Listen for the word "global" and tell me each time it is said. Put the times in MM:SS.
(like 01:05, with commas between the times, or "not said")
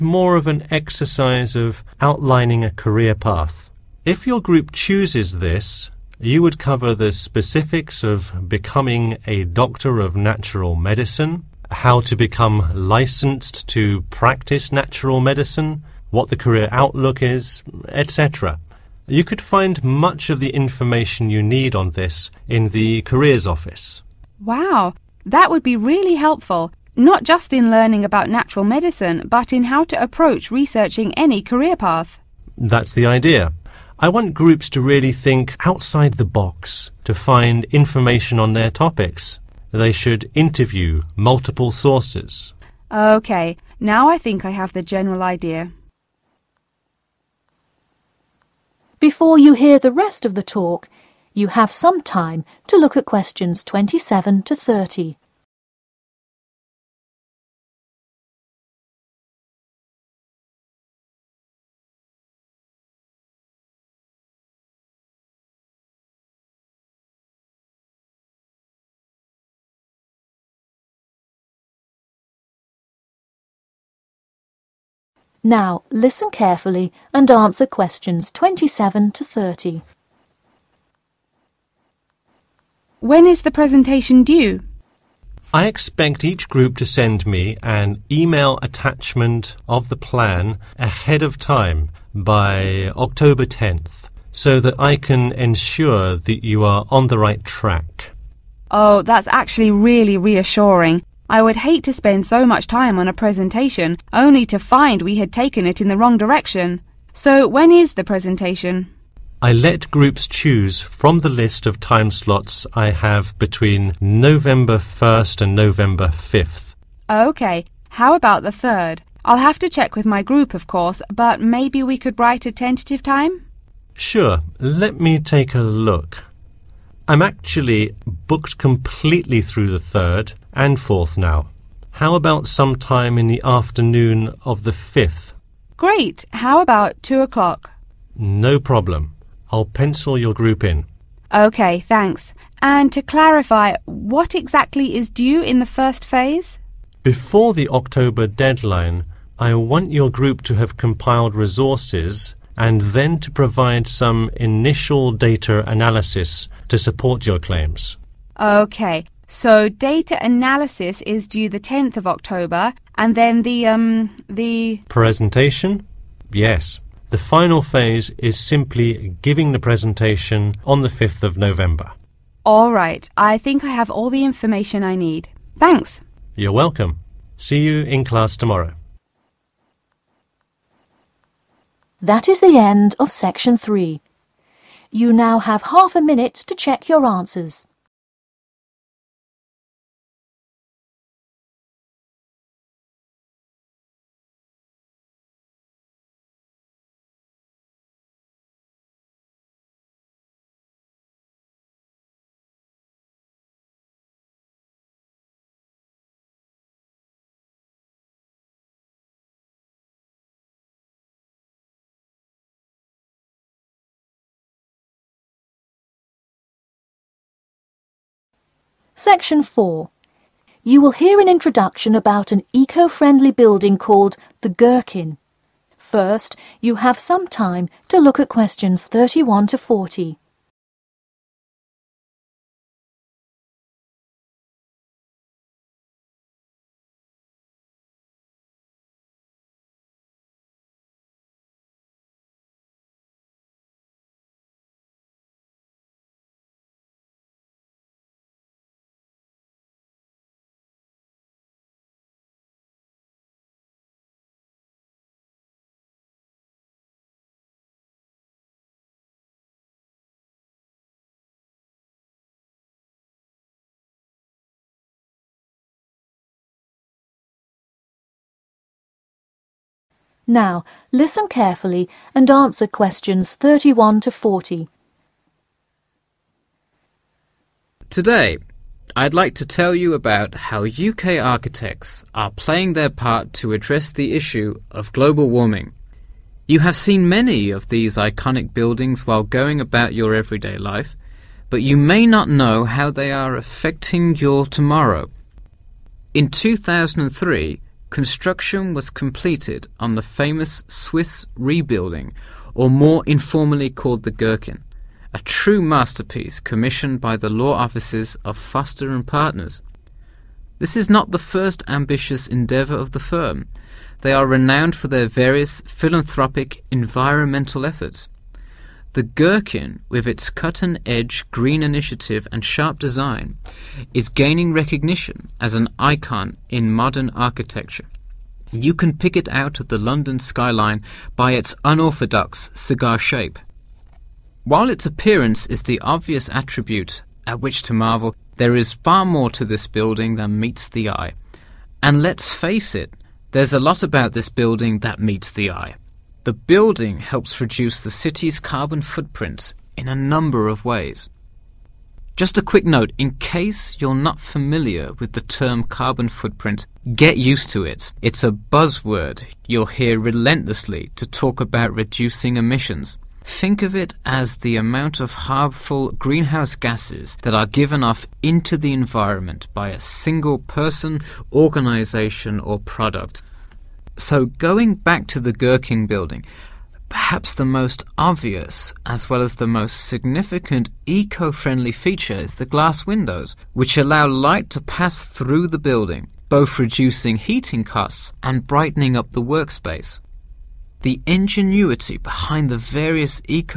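04:44.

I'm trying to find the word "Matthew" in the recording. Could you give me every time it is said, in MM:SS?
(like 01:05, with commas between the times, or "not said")
not said.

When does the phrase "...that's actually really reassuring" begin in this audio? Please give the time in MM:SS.
01:39.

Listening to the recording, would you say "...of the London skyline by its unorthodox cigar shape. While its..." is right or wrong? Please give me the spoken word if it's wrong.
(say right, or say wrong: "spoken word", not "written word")
right.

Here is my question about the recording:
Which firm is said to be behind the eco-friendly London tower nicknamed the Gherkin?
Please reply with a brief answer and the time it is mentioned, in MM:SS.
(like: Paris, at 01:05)
Foster and Partners, at 05:08.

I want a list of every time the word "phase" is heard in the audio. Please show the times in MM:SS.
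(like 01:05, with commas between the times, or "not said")
02:26, 02:47.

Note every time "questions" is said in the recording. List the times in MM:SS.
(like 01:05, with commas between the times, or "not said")
00:53, 01:17, 03:48, 04:32.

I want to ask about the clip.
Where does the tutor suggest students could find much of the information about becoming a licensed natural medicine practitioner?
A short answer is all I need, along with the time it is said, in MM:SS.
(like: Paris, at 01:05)
Careers Office, at 00:23.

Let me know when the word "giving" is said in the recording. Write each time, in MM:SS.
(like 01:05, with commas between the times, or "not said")
02:49.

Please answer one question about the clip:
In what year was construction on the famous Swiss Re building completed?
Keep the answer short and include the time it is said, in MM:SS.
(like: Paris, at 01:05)
2003, at 04:56.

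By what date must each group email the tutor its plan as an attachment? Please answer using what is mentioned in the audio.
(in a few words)
October 10th.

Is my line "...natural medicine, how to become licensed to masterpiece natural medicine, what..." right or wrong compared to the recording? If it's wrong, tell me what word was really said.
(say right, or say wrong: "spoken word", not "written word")
wrong: "practice", not "masterpiece".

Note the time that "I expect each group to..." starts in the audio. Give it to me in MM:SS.
01:25.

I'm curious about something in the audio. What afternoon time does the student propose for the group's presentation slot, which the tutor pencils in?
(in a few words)
2 o'clock.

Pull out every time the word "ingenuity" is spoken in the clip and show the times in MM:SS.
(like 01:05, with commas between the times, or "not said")
06:31.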